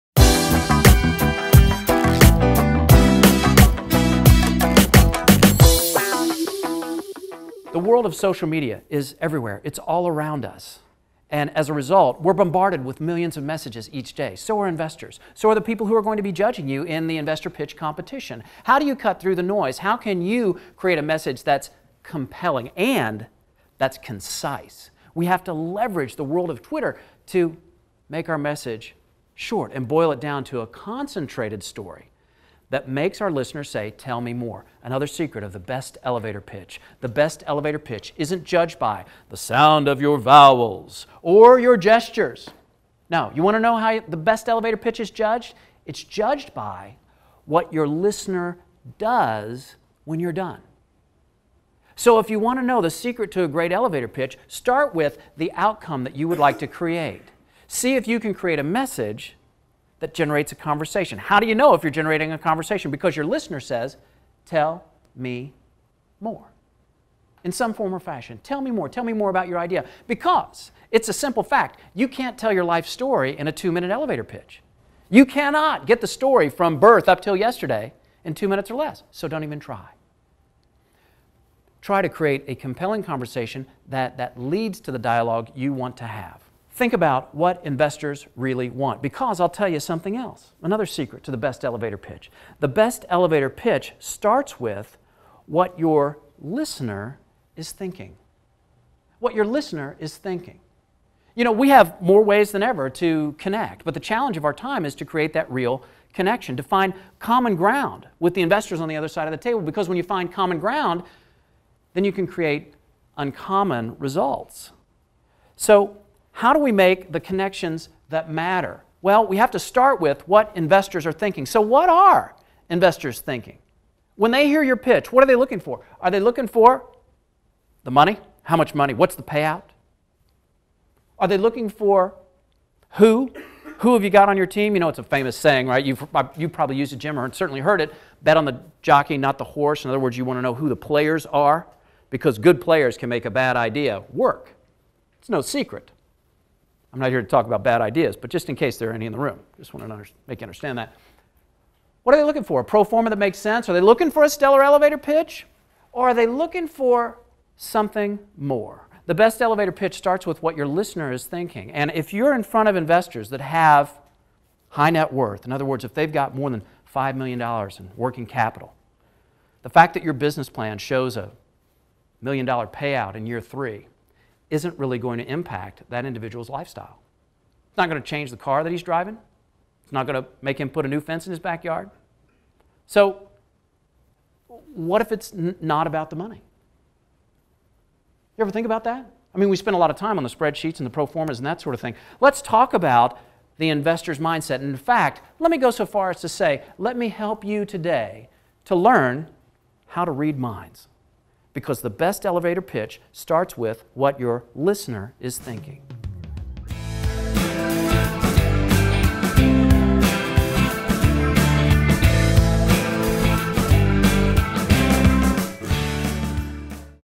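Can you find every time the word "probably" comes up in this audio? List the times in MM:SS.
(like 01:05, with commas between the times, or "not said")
02:16.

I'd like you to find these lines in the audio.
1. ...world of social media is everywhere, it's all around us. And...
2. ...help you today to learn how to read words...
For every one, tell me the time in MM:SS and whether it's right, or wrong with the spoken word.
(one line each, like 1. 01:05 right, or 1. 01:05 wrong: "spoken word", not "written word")
1. 00:07 right
2. 03:17 wrong: "minds", not "words".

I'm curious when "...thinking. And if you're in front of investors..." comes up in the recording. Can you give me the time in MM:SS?
02:41.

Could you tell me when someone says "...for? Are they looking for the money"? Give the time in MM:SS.
02:05.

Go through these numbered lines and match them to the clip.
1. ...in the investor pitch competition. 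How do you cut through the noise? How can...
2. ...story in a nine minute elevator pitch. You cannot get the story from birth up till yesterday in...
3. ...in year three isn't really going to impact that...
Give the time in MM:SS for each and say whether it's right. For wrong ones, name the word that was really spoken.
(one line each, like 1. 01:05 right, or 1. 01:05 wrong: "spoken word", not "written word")
1. 00:16 right
2. 01:12 wrong: "two", not "nine"
3. 02:53 right.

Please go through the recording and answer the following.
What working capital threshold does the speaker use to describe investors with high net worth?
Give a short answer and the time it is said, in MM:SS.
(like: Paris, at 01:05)
$5 million, at 02:46.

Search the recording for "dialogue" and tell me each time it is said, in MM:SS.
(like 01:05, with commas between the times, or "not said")
01:24.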